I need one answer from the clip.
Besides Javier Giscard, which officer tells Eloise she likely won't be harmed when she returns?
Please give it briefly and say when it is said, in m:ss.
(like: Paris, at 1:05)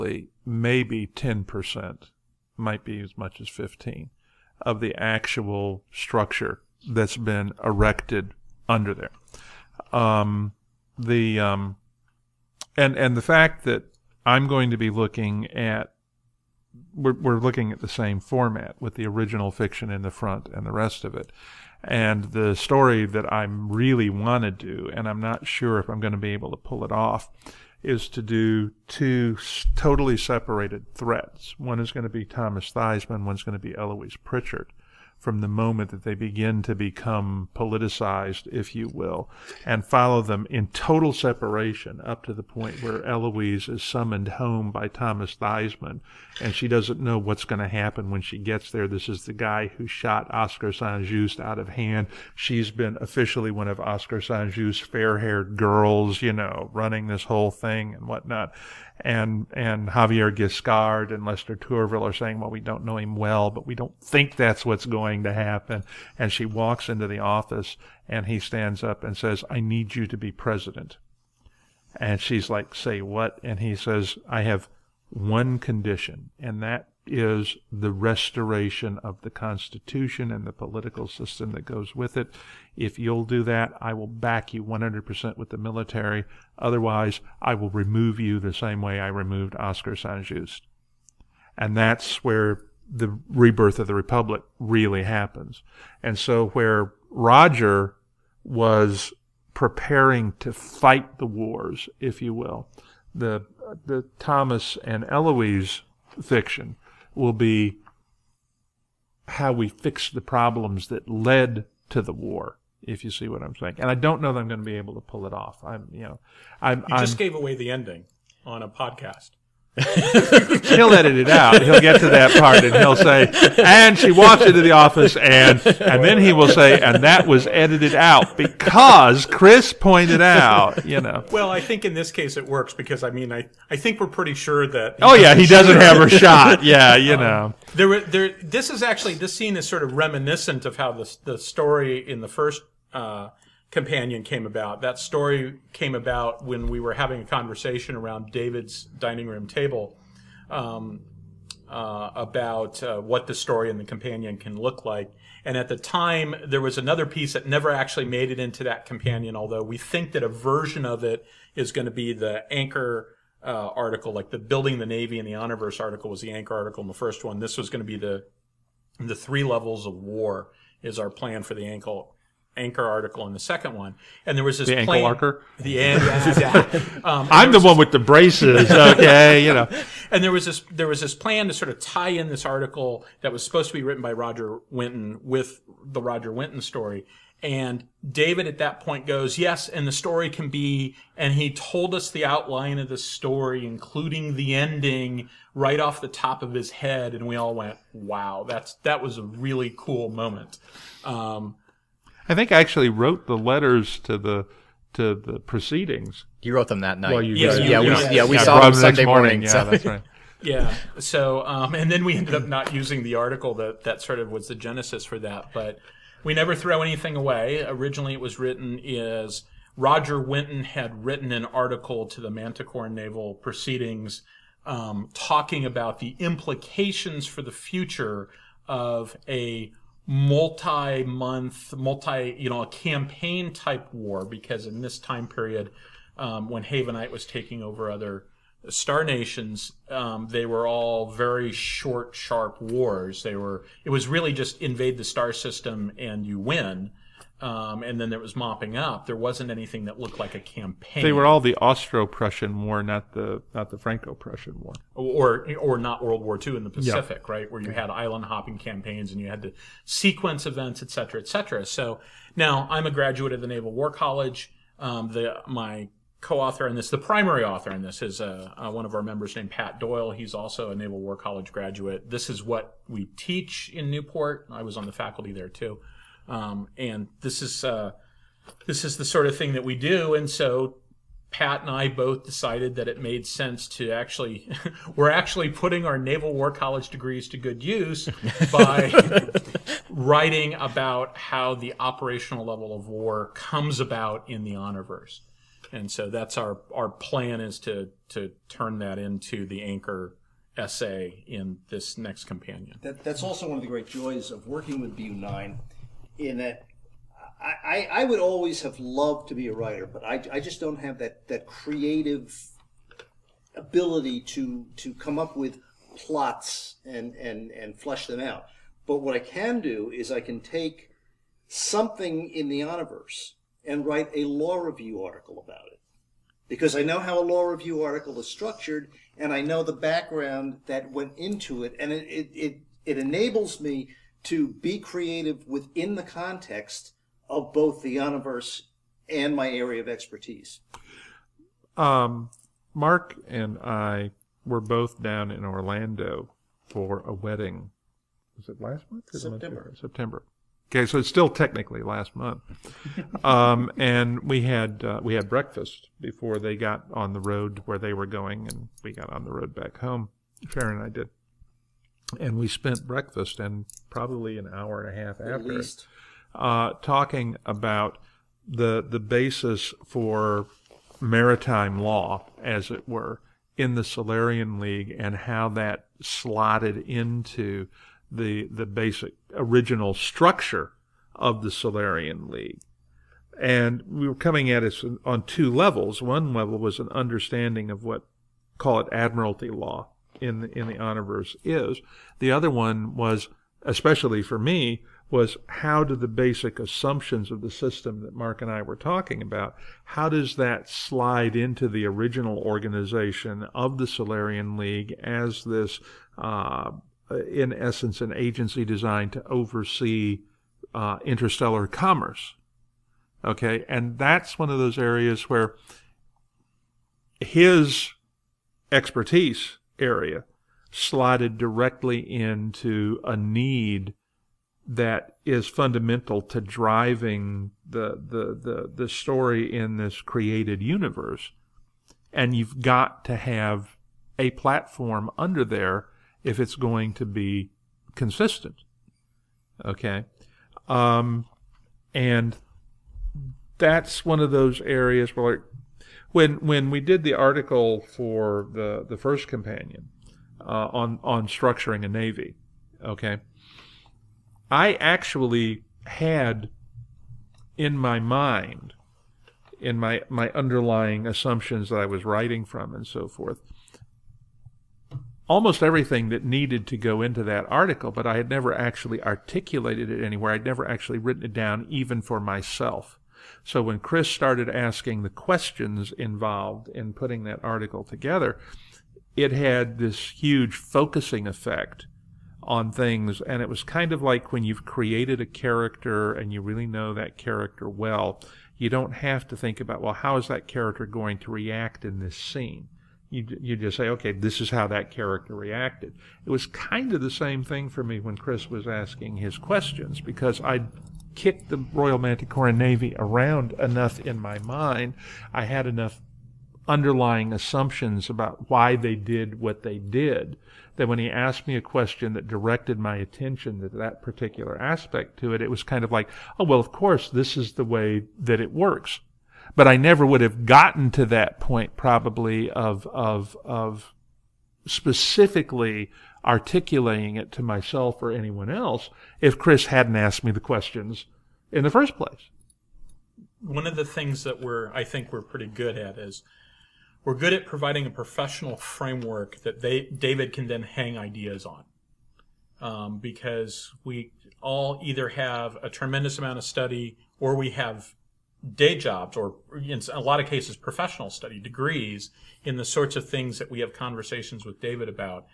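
Lester Tourville, at 1:01.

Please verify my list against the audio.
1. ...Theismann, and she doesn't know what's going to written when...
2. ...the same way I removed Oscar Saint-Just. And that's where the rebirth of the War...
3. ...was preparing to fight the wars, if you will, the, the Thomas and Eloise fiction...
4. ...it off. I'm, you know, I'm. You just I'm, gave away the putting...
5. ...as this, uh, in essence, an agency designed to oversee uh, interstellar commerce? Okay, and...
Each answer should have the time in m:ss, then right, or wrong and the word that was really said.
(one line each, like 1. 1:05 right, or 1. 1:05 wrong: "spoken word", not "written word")
1. 0:45 wrong: "happen", not "written"
2. 1:28 wrong: "Republic", not "War"
3. 1:38 right
4. 1:55 wrong: "ending", not "putting"
5. 6:45 right.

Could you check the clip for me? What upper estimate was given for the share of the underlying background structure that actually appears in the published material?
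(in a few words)
15 percent.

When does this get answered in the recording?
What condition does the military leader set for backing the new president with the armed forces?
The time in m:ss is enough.
1:17.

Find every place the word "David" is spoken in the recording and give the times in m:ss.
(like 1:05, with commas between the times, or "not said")
2:28, 3:08, 8:59, 9:14.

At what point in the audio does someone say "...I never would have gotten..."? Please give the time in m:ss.
8:39.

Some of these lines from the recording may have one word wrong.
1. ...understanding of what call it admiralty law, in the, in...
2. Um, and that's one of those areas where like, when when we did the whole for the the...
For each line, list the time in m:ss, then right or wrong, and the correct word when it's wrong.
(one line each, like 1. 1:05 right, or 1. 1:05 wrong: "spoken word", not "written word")
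1. 6:26 right
2. 7:20 wrong: "article", not "whole".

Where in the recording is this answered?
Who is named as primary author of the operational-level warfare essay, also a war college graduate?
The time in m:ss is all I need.
4:29.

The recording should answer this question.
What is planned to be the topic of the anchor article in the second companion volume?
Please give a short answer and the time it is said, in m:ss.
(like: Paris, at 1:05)
The three levels of war, at 2:49.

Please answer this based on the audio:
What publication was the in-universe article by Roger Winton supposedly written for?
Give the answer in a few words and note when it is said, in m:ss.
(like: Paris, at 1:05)
Manticore Naval Proceedings, at 3:42.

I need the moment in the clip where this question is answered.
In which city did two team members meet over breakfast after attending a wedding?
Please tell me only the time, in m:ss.
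5:45.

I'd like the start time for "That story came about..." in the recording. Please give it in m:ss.
2:24.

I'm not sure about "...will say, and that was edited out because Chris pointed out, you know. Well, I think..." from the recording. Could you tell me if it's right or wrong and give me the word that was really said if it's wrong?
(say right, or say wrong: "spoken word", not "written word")
right.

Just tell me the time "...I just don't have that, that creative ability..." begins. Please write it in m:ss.
5:10.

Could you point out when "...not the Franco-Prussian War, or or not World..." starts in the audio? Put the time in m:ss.
4:13.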